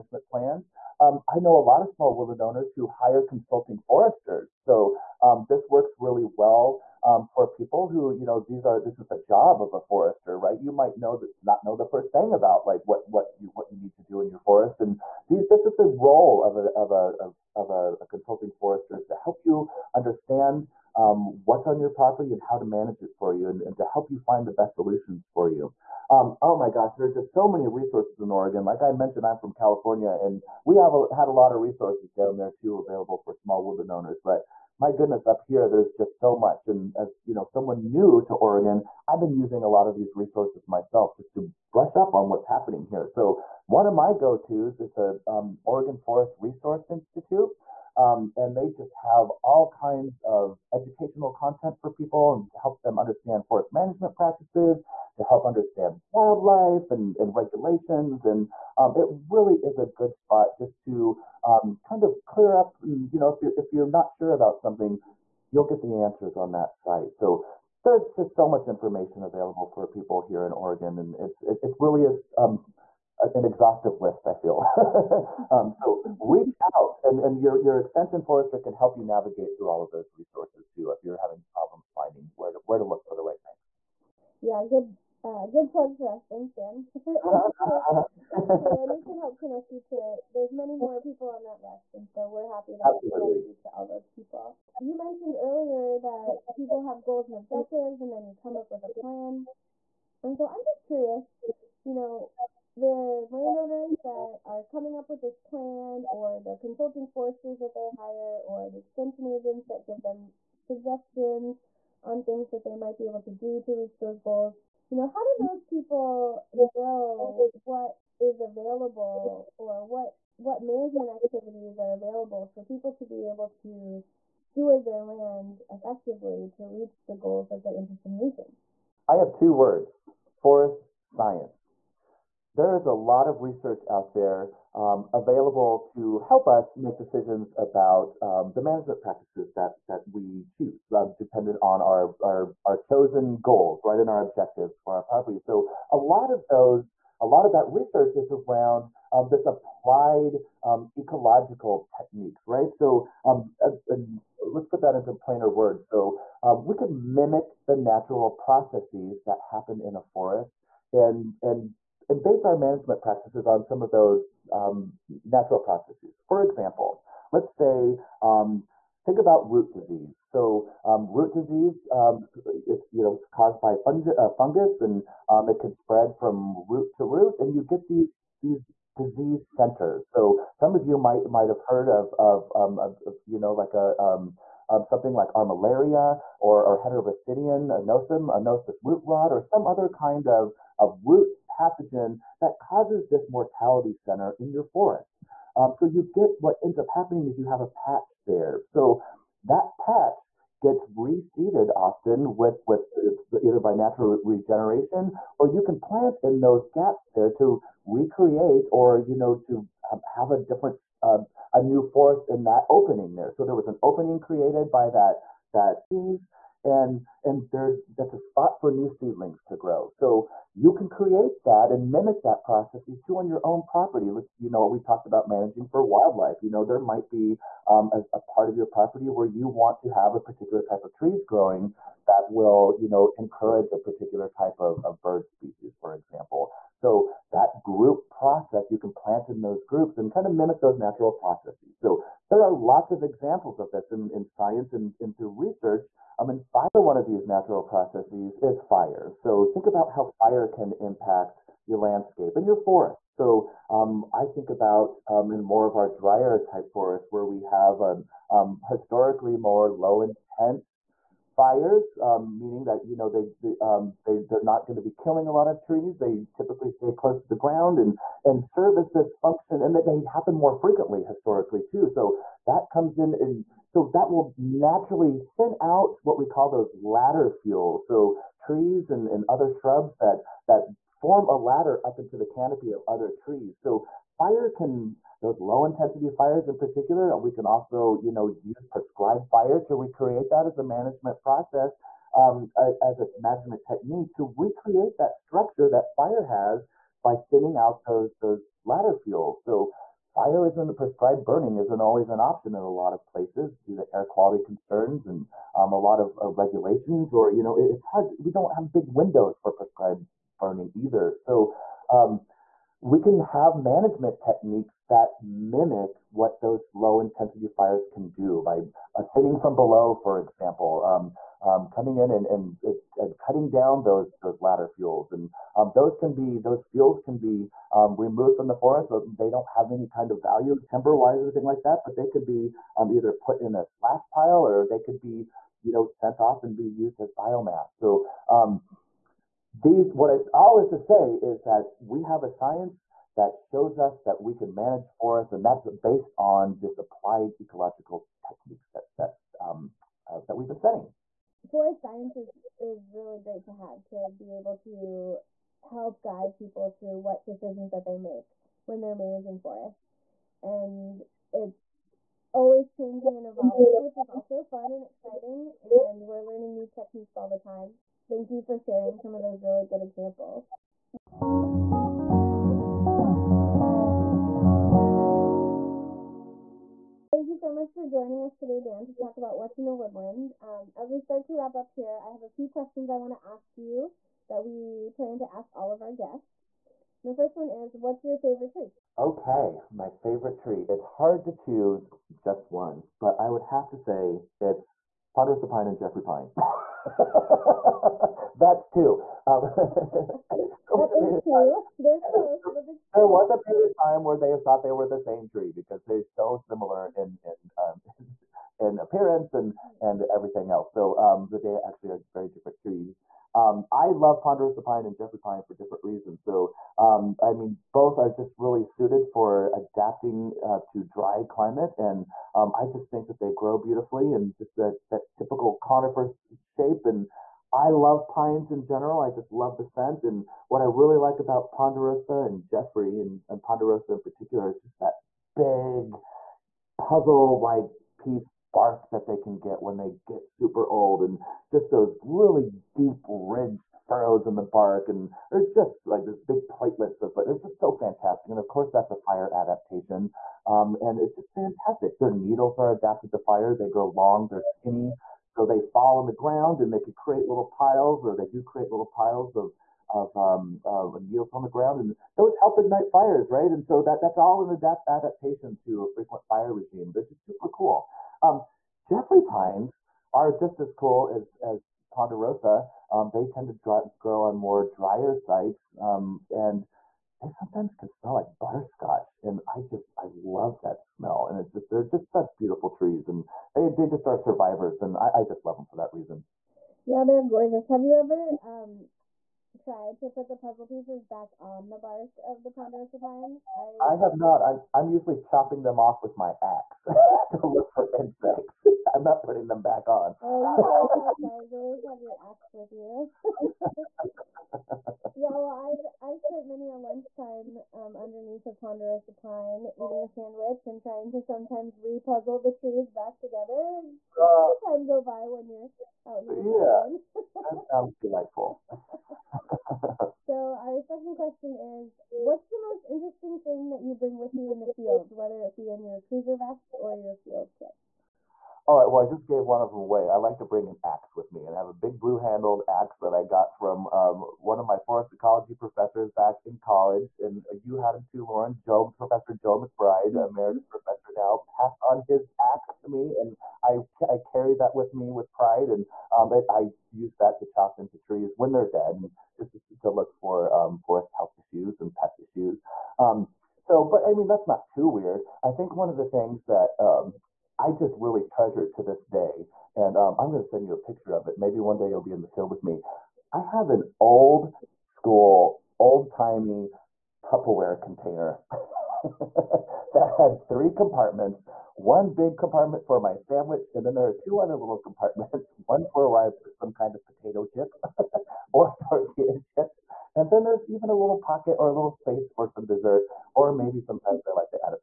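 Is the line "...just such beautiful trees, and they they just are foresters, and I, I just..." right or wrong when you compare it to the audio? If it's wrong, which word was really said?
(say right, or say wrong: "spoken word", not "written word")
wrong: "survivors", not "foresters".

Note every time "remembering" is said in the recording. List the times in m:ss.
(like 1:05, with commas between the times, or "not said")
not said.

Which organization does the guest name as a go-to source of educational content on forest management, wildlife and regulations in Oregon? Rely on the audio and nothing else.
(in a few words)
Oregon Forest Resource Institute.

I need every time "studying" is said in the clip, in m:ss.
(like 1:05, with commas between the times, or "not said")
5:50.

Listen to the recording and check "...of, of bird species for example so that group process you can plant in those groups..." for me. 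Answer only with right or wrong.
right.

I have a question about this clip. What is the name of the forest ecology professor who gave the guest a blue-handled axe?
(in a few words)
Joe McBride.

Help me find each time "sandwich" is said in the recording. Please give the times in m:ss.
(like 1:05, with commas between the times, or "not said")
8:30, 9:33.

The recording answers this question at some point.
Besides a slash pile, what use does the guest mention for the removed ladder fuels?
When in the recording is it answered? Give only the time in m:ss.
5:37.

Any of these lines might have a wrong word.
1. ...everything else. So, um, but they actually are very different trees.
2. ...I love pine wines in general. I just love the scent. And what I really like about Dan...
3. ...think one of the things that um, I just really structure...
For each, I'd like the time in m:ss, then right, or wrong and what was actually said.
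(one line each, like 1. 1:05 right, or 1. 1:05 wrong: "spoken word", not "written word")
1. 6:50 right
2. 7:07 wrong: "Ponderosa", not "Dan"
3. 9:15 wrong: "treasure", not "structure".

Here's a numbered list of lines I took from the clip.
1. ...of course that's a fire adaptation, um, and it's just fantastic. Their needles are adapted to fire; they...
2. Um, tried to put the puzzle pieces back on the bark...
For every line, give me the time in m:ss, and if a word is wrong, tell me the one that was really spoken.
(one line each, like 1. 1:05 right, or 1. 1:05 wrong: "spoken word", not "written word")
1. 7:28 right
2. 8:08 right.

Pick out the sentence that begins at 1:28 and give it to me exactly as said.
And we can help connect you to, there's many more people on that list.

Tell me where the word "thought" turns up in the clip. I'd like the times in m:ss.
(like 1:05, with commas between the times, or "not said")
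6:44.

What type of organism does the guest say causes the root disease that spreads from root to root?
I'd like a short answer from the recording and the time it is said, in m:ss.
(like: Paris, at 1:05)
fungi, at 2:53.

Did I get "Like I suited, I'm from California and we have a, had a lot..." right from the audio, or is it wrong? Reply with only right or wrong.
wrong.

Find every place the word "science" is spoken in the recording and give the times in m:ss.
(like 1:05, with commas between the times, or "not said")
2:11, 4:04, 5:42, 5:51.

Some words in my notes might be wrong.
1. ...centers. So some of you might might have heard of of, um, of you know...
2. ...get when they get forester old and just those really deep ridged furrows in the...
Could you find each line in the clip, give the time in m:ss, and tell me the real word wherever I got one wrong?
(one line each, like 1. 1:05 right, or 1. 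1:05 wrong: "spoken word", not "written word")
1. 2:59 right
2. 7:19 wrong: "super", not "forester".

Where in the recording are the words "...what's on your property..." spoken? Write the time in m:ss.
0:21.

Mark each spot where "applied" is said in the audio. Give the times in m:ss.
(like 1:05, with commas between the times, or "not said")
2:29, 5:46.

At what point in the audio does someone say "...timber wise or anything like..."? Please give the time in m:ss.
5:30.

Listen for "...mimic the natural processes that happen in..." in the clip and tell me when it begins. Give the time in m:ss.
2:36.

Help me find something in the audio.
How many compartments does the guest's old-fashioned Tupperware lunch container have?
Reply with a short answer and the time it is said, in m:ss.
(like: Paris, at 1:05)
3, at 9:30.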